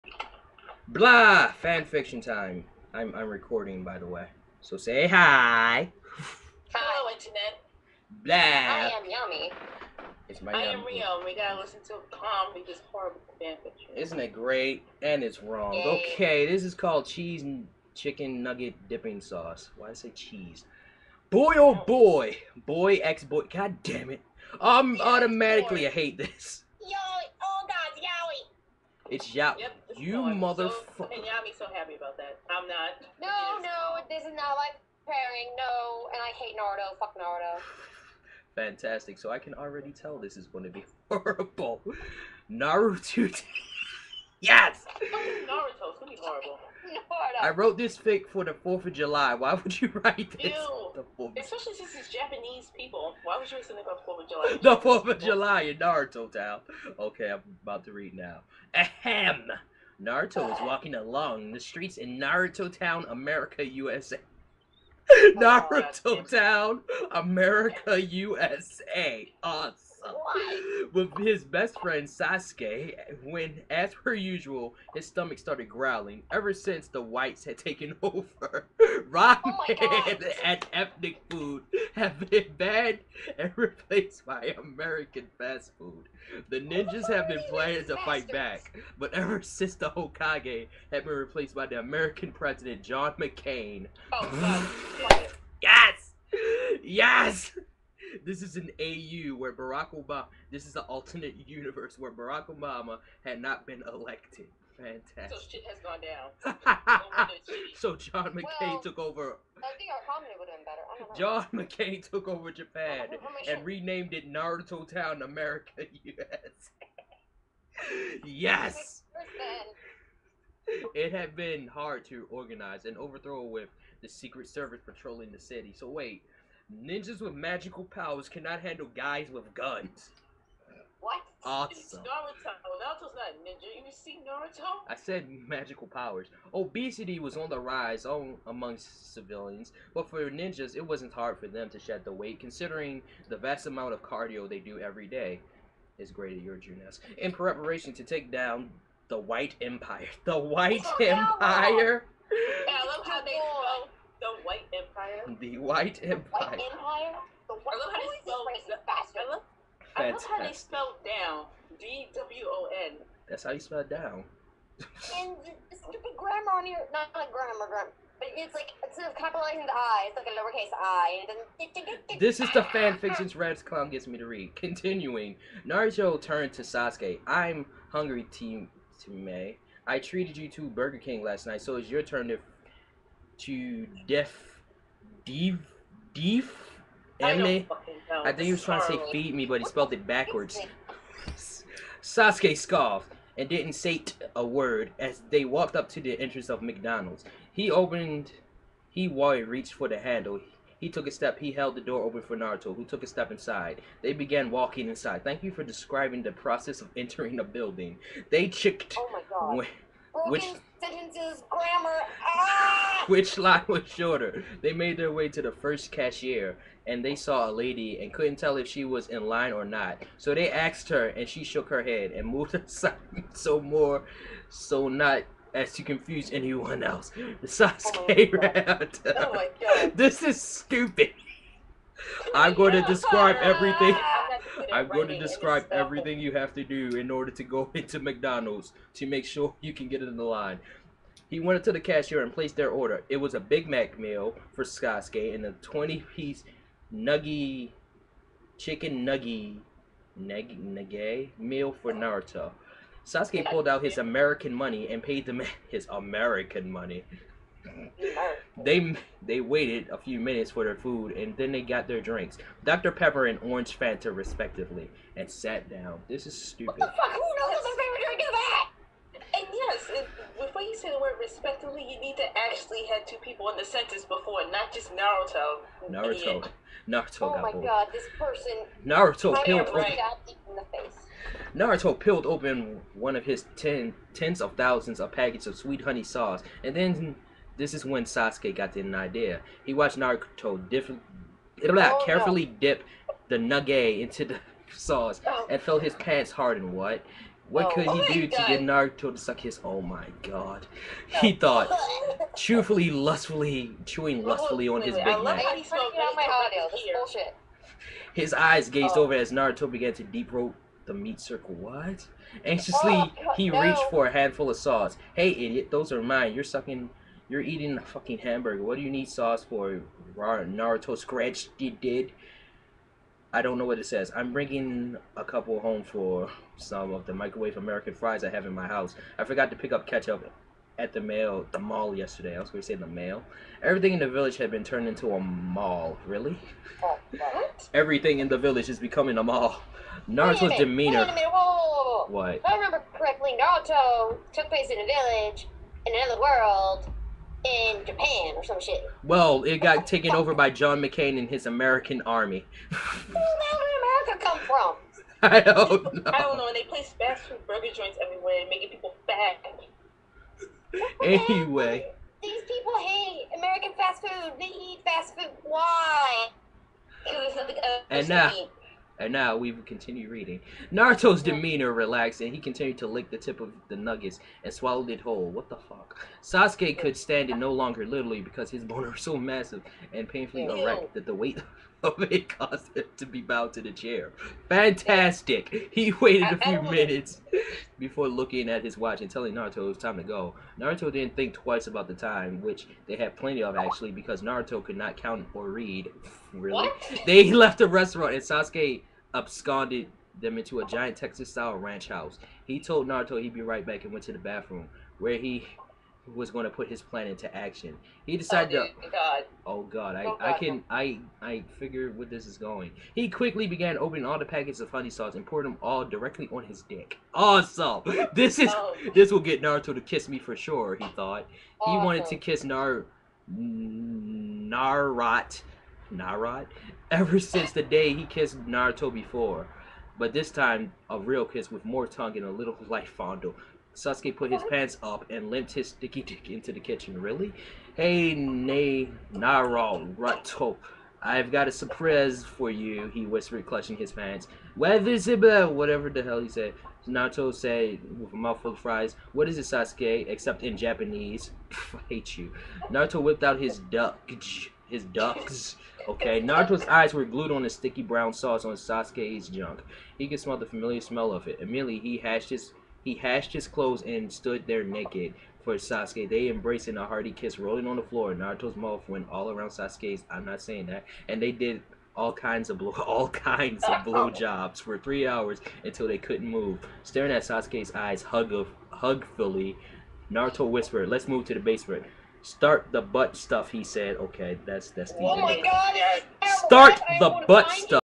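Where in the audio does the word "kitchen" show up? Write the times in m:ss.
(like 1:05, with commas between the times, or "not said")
7:16.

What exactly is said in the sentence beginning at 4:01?
He went into to the cashier and placed their order.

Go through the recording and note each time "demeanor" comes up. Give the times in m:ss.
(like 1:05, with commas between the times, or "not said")
5:40, 6:11.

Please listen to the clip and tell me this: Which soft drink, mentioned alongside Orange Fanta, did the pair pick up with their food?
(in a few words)
Dr. Pepper.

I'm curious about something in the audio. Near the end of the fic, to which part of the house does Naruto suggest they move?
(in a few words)
The basement.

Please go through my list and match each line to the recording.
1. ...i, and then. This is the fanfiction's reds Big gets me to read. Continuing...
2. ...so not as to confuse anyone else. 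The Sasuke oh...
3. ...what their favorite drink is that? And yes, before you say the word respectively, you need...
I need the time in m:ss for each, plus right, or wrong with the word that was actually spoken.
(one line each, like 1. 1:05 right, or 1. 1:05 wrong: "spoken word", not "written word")
1. 2:50 wrong: "Clown", not "Big"
2. 3:44 right
3. 4:27 right.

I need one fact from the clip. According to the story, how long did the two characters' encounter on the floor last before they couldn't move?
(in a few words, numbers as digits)
3 hours.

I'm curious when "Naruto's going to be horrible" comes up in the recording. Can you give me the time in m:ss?
0:45.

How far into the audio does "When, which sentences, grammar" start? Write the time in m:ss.
3:29.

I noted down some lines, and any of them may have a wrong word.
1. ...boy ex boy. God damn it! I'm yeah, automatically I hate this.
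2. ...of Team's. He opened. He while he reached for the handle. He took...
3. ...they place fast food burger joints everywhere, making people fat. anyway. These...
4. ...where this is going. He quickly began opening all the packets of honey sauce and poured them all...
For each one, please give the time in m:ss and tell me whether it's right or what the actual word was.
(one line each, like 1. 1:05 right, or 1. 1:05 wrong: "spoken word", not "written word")
1. 0:22 right
2. 3:16 wrong: "McDonald", not "Team"
3. 5:56 right
4. 6:51 right.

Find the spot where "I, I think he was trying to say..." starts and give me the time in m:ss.
3:08.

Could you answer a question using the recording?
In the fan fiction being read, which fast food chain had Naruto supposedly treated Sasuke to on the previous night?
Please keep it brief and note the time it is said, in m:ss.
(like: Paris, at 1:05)
Burger King, at 3:00.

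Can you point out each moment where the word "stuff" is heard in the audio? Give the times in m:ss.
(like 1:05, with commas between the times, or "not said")
8:03, 8:07.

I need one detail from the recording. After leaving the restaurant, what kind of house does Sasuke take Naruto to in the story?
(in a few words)
Texas-style ranch house.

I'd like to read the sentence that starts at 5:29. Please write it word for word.
I forgot to pick up ketchup at the mail, the mall yesterday.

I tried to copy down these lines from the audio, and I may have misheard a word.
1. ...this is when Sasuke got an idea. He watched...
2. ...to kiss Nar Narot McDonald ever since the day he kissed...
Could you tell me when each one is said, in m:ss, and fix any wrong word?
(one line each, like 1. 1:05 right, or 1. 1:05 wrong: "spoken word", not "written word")
1. 4:47 right
2. 7:02 wrong: "Narod", not "McDonald".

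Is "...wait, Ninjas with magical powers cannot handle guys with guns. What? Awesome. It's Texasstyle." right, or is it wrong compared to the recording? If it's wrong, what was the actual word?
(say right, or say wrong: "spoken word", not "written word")
wrong: "Naruto", not "Texasstyle".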